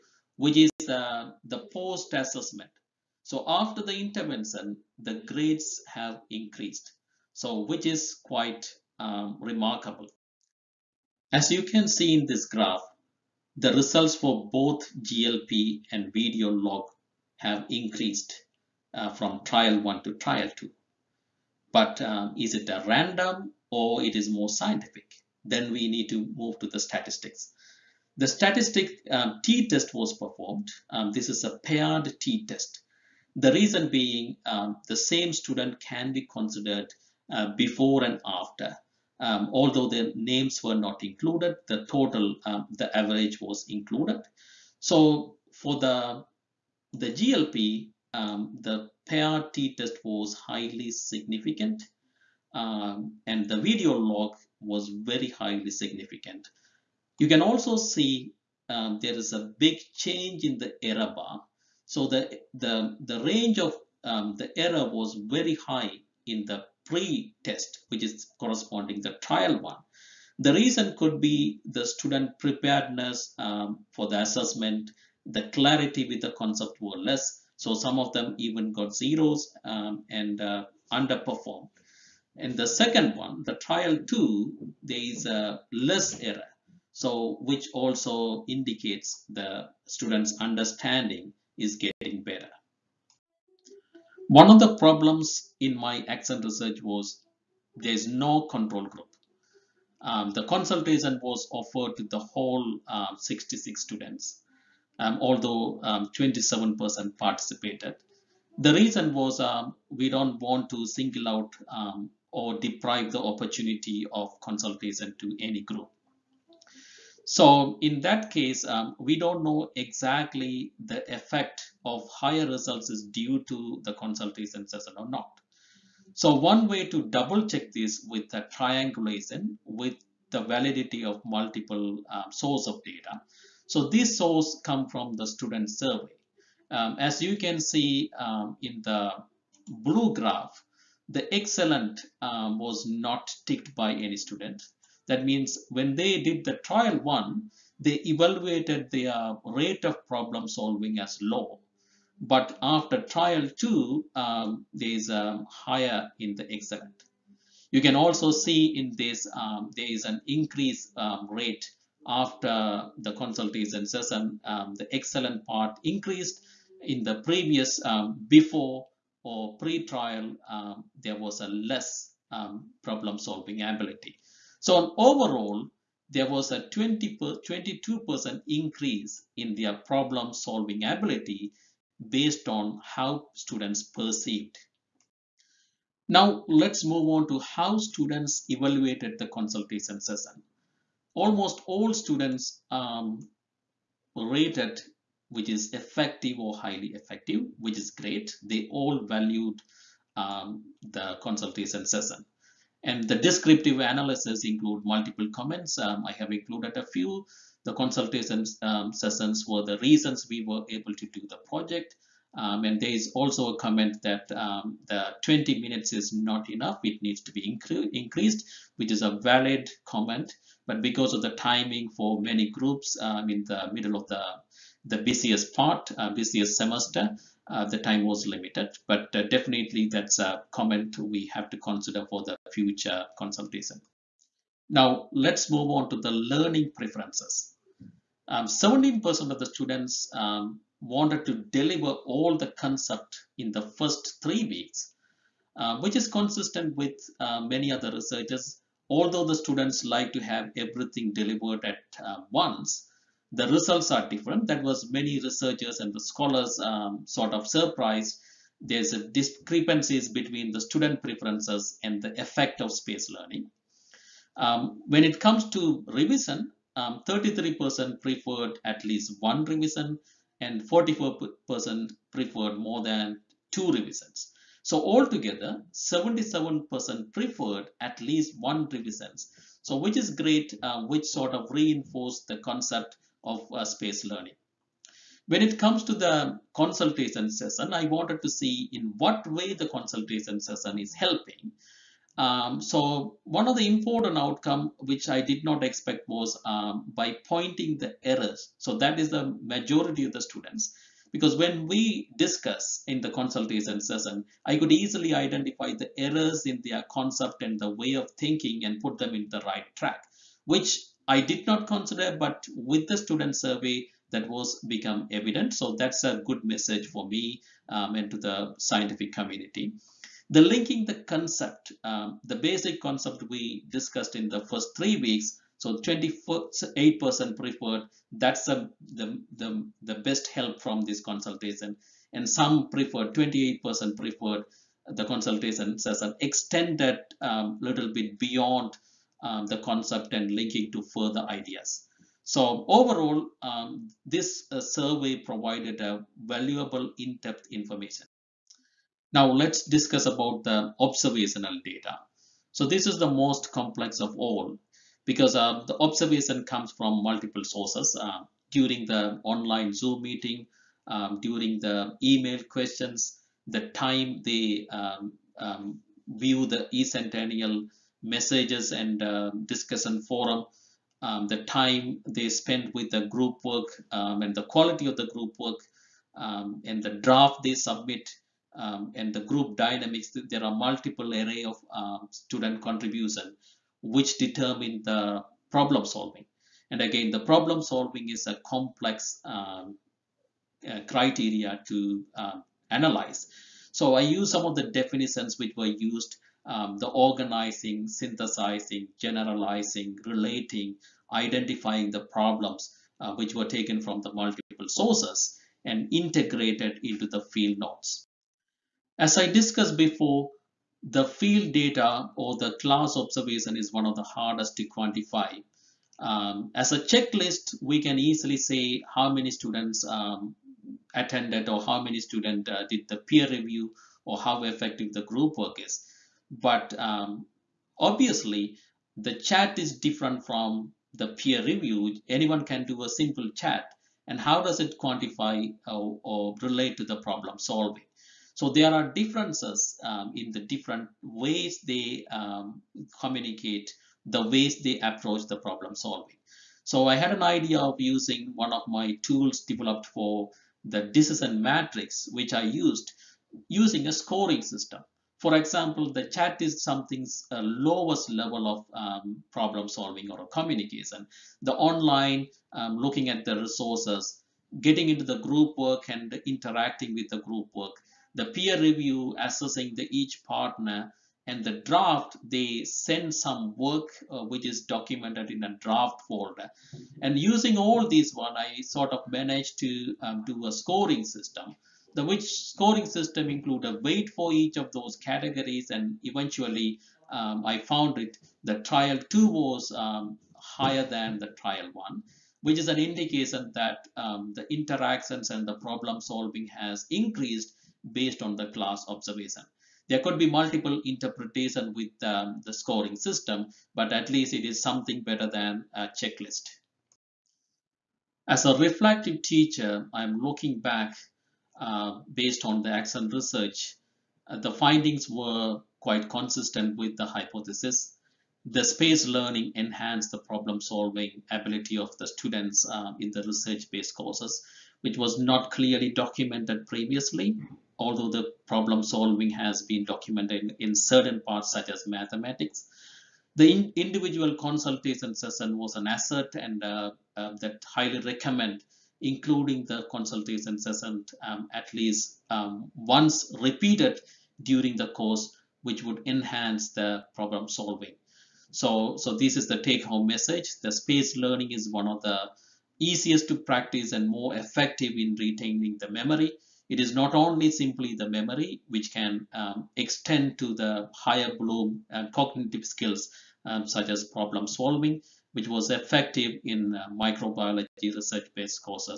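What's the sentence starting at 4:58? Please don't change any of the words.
So that is the majority of the students.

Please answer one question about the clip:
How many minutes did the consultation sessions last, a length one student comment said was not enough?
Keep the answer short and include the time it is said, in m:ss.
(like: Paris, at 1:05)
20 minutes, at 3:35.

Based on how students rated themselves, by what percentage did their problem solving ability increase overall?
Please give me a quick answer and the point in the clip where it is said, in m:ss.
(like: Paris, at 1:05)
22%, at 2:56.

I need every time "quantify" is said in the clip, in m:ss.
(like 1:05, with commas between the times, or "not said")
6:54, 7:14.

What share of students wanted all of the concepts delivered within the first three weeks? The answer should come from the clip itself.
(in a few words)
17%.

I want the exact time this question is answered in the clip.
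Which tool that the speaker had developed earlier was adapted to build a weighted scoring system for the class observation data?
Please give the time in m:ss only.
7:30.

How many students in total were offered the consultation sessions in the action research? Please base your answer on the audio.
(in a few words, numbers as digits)
66.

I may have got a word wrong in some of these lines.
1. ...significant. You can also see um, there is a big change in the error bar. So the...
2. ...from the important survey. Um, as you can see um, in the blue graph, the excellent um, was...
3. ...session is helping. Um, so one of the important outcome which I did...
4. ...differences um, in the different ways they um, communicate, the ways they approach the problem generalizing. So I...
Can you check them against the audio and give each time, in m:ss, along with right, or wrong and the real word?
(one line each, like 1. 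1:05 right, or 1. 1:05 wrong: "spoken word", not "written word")
1. 0:55 right
2. 2:14 wrong: "student", not "important"
3. 4:50 right
4. 7:18 wrong: "solving", not "generalizing".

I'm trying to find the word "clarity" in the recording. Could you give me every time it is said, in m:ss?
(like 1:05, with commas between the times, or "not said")
1:15.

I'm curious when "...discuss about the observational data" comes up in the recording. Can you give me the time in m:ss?
5:49.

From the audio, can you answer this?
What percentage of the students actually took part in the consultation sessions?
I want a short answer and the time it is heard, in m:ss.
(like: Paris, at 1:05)
27%, at 1:46.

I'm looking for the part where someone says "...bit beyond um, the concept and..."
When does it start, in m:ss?
5:37.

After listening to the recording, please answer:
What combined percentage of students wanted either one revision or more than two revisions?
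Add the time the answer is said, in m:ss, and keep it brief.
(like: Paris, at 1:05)
77%, at 4:35.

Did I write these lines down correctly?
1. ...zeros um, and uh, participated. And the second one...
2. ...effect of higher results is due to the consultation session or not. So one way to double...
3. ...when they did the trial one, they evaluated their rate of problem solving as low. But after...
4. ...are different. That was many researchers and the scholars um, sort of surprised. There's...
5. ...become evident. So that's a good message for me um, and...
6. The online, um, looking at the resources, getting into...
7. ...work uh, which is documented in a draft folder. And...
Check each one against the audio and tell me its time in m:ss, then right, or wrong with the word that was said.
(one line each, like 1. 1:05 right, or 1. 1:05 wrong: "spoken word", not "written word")
1. 1:18 wrong: "underperformed", not "participated"
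2. 2:01 right
3. 2:25 right
4. 4:13 right
5. 5:14 right
6. 7:41 right
7. 7:53 right.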